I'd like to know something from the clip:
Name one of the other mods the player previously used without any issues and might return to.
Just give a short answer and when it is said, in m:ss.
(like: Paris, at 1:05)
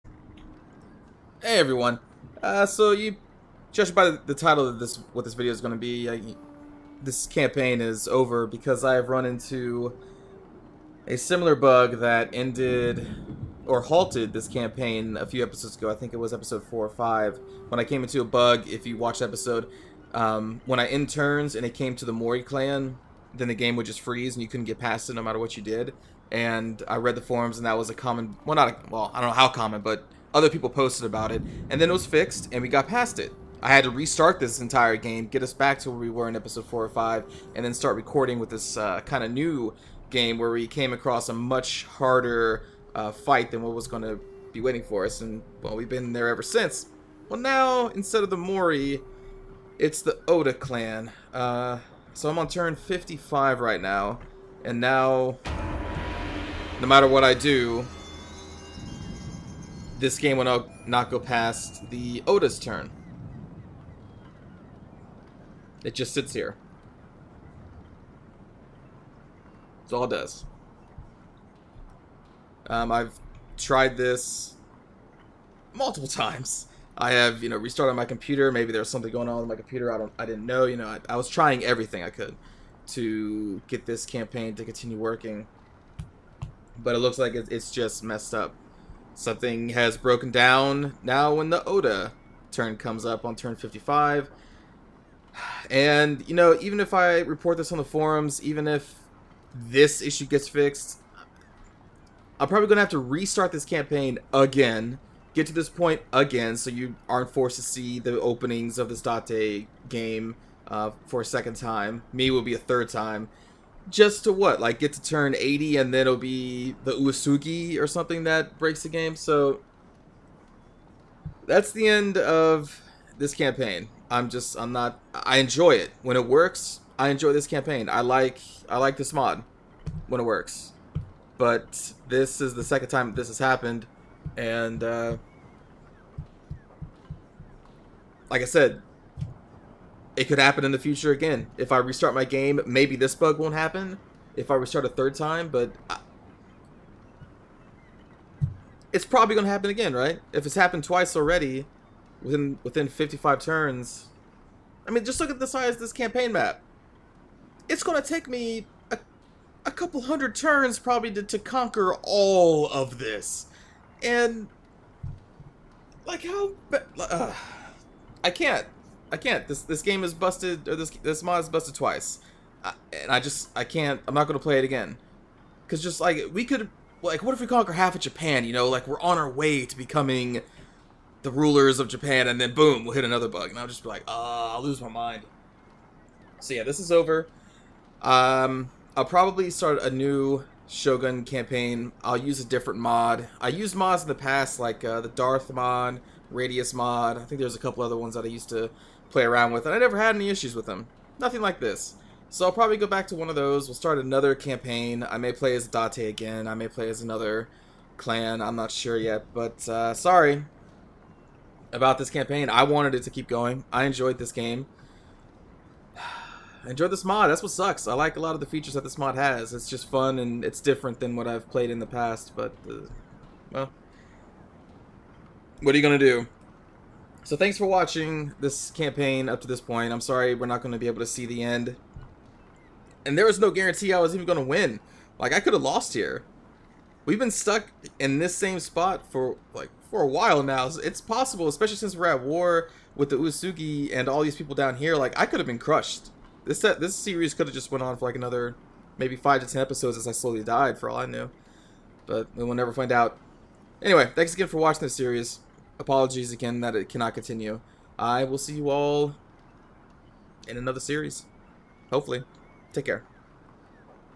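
Darth mod, at 3:15.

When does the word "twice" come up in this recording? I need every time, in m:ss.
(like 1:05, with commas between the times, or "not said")
2:30, 2:51.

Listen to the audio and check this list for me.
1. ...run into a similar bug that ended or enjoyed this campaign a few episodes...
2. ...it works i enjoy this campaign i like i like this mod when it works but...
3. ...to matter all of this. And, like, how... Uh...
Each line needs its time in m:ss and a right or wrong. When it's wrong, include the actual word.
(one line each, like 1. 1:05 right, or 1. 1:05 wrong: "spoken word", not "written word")
1. 0:09 wrong: "halted", not "enjoyed"
2. 2:06 right
3. 2:41 wrong: "conquer", not "matter".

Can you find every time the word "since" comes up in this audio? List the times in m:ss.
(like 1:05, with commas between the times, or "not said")
0:46, 4:01.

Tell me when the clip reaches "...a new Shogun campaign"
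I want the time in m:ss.
3:09.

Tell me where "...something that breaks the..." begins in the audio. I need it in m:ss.
1:57.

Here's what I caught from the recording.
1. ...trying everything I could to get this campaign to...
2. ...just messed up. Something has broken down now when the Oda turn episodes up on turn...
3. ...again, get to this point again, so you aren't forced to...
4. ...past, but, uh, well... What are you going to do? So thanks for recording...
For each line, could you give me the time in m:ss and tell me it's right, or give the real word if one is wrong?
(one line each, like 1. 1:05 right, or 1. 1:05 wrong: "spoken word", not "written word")
1. 1:21 right
2. 1:27 wrong: "comes", not "episodes"
3. 1:44 right
4. 3:41 wrong: "watching", not "recording".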